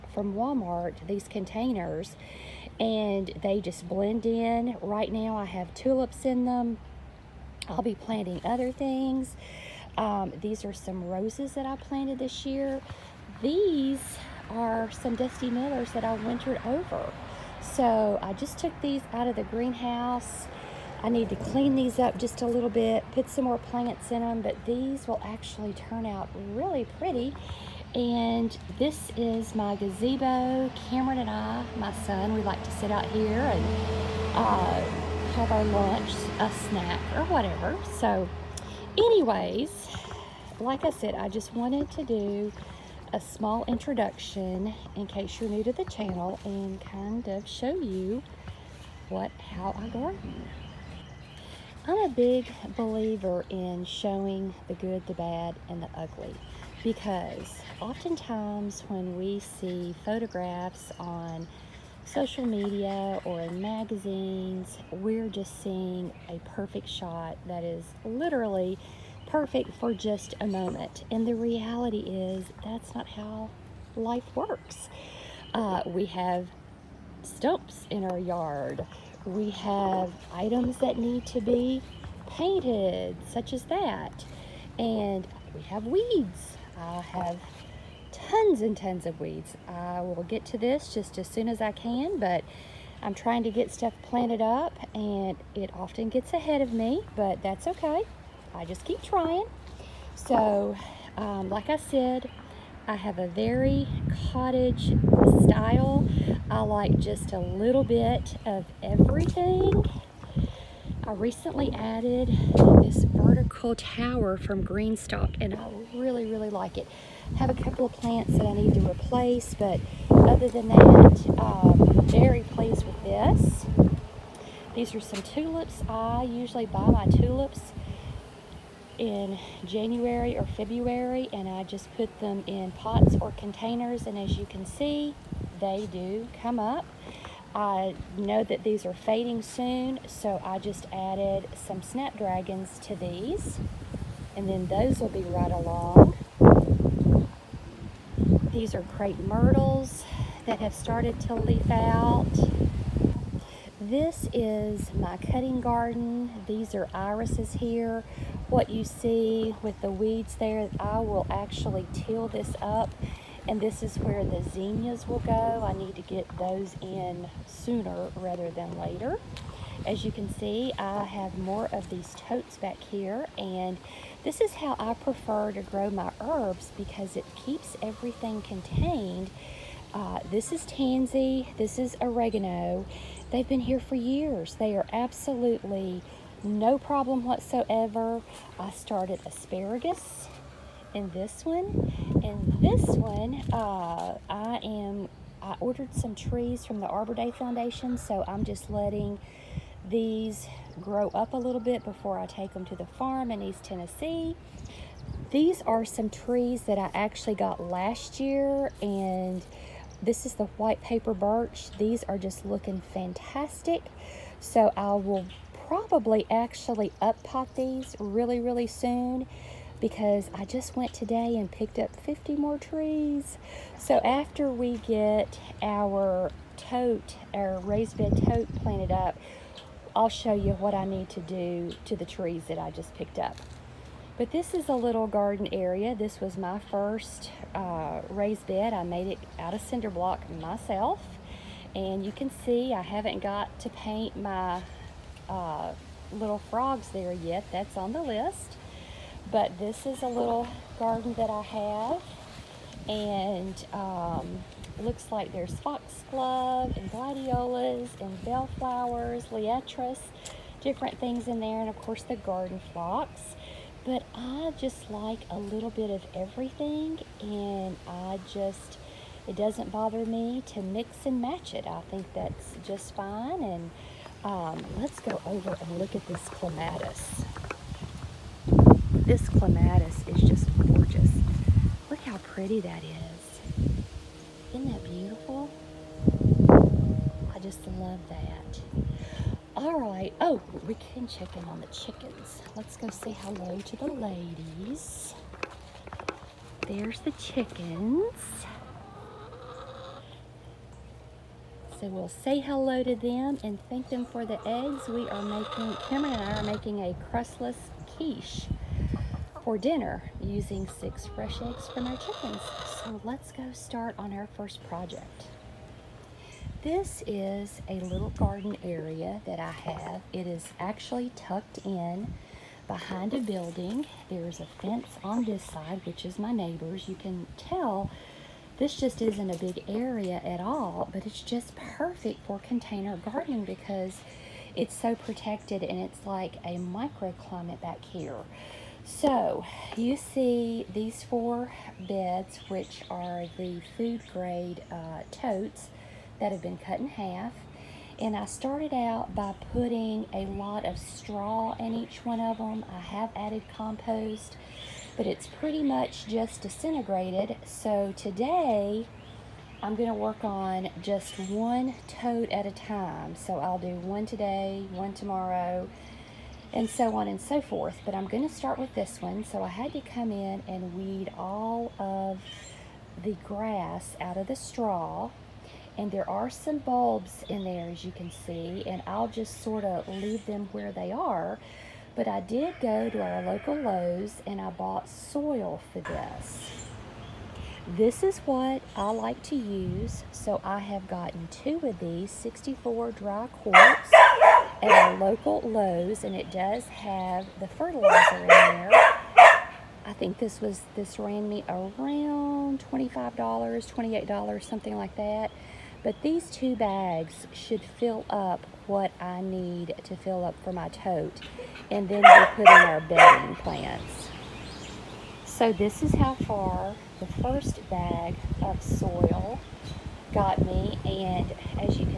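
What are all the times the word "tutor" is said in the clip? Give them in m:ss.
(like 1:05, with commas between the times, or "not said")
not said.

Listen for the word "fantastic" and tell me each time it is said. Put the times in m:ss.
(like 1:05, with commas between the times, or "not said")
3:32.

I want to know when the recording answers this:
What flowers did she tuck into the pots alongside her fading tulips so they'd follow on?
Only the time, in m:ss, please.
2:21.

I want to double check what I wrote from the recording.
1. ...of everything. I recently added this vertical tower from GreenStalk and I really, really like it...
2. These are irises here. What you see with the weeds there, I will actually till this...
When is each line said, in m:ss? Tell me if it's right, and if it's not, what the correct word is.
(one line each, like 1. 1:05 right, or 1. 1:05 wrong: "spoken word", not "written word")
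1. 1:48 right
2. 2:36 right.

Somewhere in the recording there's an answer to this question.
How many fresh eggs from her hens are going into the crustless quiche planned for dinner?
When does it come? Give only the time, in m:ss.
5:10.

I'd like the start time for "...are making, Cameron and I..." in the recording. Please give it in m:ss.
5:05.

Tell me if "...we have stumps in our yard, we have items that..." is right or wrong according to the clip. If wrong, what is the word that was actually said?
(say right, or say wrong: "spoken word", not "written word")
right.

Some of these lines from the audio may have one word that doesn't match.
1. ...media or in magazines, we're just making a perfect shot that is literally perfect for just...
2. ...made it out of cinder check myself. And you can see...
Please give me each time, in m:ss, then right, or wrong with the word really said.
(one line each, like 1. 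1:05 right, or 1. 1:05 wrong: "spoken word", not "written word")
1. 1:02 wrong: "seeing", not "making"
2. 3:58 wrong: "block", not "check".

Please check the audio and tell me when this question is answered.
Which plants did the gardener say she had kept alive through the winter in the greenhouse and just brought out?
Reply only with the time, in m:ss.
0:15.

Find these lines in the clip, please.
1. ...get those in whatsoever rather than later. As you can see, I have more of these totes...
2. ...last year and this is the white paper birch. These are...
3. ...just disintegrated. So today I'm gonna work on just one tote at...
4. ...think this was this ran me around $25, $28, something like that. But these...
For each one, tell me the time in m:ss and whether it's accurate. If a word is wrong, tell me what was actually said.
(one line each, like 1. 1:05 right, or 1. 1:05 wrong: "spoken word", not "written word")
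1. 2:46 wrong: "sooner", not "whatsoever"
2. 3:27 right
3. 5:56 right
4. 6:39 right.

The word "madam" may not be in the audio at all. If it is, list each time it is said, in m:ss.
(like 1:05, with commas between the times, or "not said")
not said.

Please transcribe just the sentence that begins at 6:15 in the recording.
And there are some bulbs in there, as you can see, and I'll just sort of leave them where they are.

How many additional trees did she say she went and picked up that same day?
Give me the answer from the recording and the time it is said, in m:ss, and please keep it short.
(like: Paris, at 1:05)
50, at 3:42.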